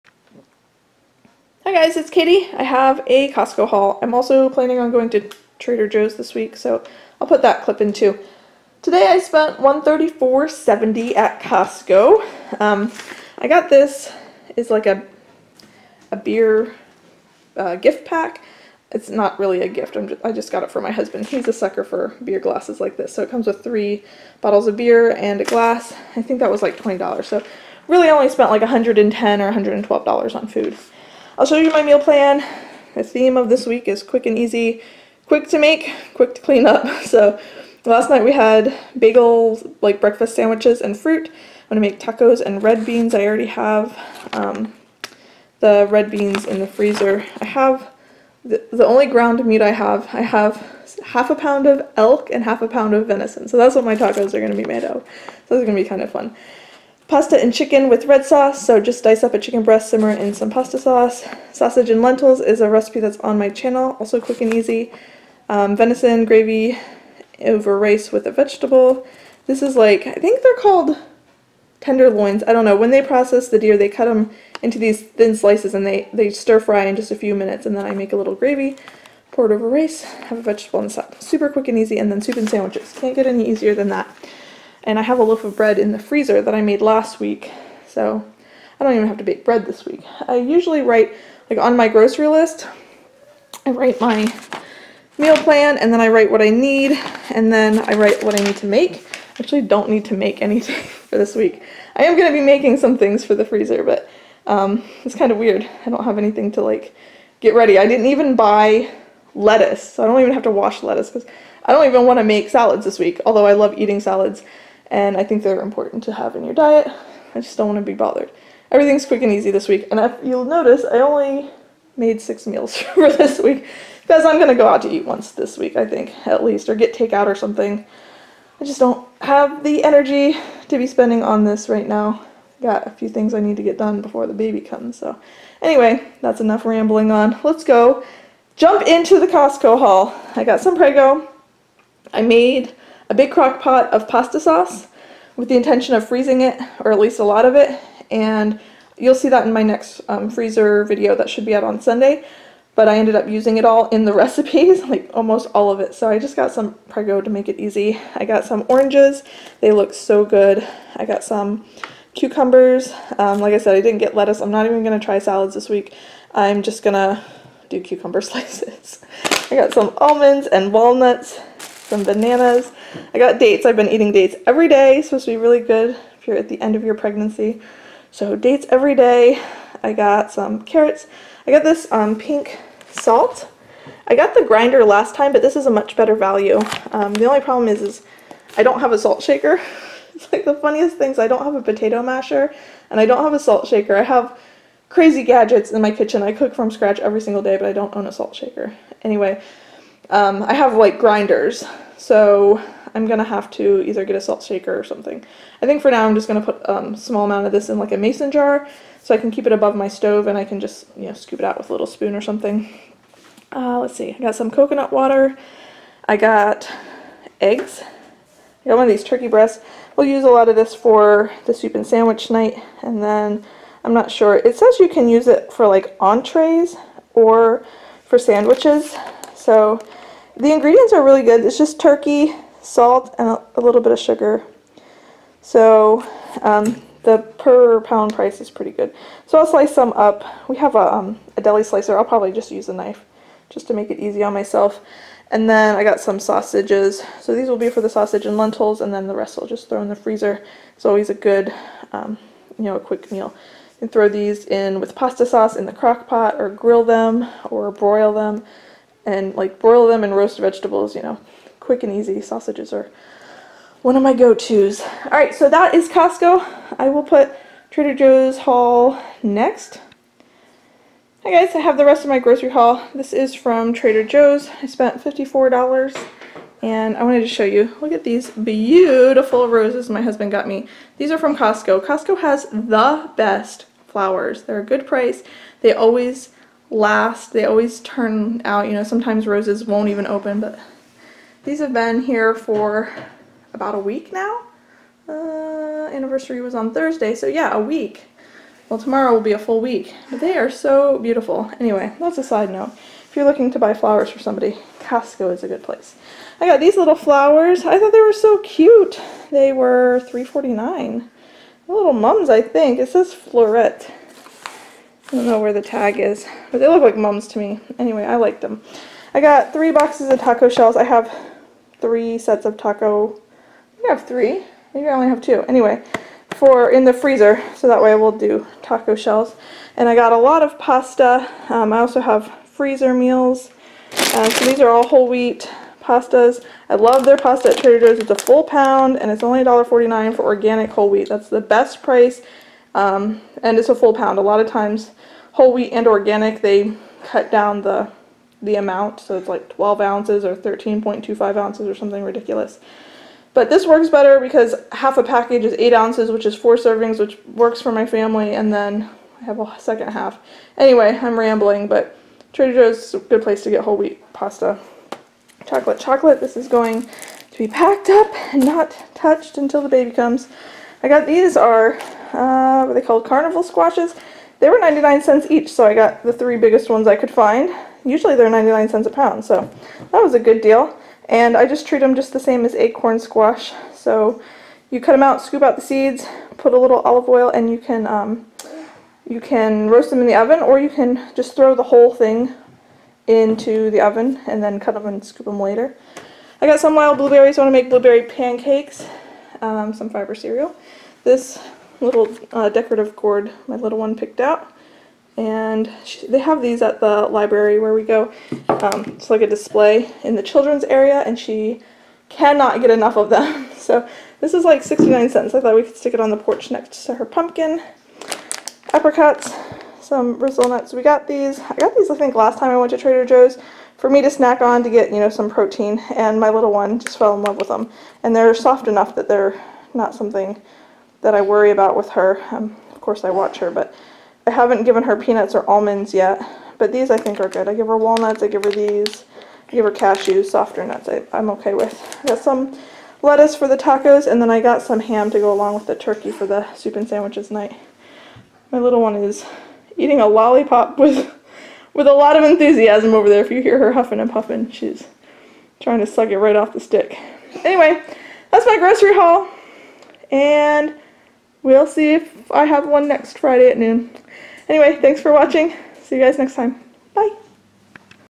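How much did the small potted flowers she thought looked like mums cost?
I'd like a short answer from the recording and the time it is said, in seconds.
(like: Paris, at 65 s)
$3.49, at 310 s.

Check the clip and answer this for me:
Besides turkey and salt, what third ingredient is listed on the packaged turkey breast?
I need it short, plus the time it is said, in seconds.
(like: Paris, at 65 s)
sugar, at 233 s.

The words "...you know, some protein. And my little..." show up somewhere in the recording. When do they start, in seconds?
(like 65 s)
424 s.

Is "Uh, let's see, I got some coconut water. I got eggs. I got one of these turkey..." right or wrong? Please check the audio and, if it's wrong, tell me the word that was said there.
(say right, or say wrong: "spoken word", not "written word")
right.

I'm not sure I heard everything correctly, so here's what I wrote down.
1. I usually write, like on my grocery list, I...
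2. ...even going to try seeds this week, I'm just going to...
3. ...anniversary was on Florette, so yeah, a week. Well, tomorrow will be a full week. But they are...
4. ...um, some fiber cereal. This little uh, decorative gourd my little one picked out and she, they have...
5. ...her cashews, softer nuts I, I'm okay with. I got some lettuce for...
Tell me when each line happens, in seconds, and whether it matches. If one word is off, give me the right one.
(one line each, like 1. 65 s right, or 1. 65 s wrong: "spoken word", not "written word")
1. 90 s right
2. 164 s wrong: "salads", not "seeds"
3. 295 s wrong: "Thursday", not "Florette"
4. 399 s right
5. 439 s right.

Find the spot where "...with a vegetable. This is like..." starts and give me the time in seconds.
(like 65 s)
68 s.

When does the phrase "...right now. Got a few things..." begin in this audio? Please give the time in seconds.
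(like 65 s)
131 s.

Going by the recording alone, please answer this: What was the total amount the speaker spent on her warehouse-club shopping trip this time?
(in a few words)
$134.70.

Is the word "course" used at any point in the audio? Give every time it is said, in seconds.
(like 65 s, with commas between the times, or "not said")
432 s.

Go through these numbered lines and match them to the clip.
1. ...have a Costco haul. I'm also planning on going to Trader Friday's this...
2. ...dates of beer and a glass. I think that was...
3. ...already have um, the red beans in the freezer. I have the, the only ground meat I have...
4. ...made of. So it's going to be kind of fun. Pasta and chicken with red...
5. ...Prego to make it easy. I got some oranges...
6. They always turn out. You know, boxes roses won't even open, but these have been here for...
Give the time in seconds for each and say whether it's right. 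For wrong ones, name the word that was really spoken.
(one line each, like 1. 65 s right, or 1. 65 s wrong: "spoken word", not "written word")
1. 2 s wrong: "Joe", not "Friday"
2. 24 s wrong: "bottles", not "dates"
3. 43 s right
4. 54 s right
5. 156 s right
6. 287 s wrong: "sometimes", not "boxes".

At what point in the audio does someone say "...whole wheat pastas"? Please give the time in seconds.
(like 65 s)
334 s.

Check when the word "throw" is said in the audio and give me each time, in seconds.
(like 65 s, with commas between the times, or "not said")
249 s, 253 s, 391 s.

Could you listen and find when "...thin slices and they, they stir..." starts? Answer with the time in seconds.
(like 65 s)
75 s.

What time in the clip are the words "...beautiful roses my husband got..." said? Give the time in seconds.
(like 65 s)
278 s.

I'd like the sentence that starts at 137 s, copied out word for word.
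Let's go jump into the Costco haul.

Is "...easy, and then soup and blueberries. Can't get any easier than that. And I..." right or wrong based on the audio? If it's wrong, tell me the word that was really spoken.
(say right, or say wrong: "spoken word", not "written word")
wrong: "sandwiches", not "blueberries".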